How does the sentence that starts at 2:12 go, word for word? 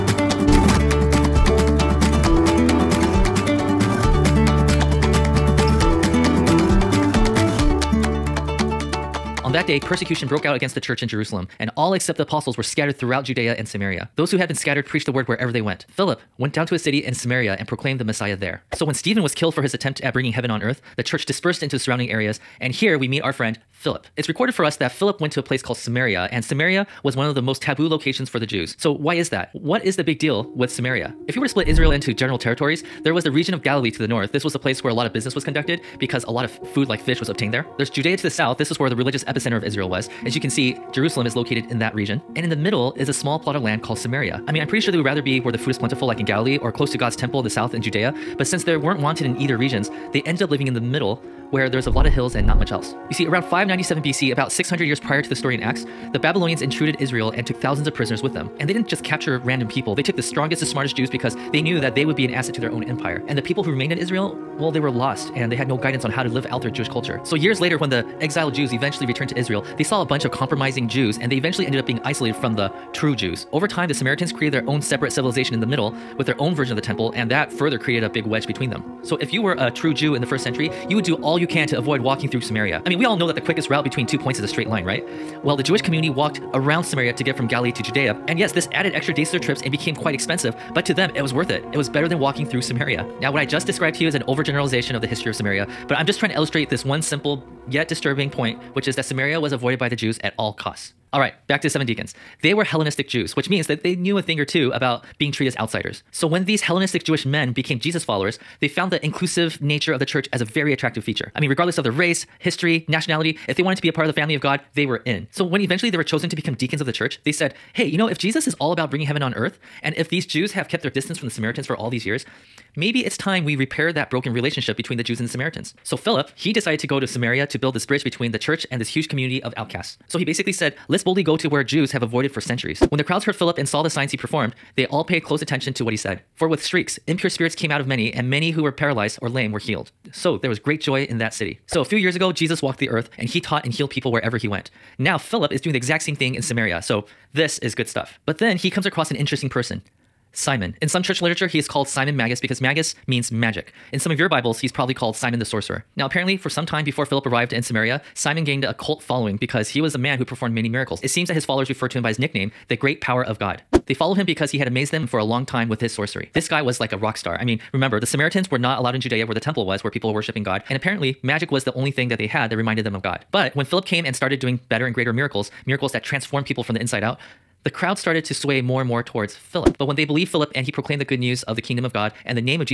When the crowds heard Philip and saw the signs he performed, they all paid close attention to what he said.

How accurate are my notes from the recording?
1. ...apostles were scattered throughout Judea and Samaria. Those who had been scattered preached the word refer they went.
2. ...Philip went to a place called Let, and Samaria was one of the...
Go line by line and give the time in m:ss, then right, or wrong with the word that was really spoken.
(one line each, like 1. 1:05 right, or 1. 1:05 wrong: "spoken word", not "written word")
1. 0:12 wrong: "wherever", not "refer"
2. 0:24 wrong: "Samaria", not "Let".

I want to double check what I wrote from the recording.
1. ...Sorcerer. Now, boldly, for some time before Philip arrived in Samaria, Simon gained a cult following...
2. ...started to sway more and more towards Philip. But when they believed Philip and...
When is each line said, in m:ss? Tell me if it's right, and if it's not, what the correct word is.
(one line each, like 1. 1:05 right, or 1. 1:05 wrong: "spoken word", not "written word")
1. 2:35 wrong: "apparently", not "boldly"
2. 2:57 right.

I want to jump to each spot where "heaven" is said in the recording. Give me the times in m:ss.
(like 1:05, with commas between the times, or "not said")
0:20, 1:59.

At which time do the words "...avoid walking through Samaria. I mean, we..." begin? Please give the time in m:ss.
1:21.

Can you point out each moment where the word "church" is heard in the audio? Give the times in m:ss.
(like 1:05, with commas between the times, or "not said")
0:10, 0:21, 1:50, 1:56, 2:08, 2:31.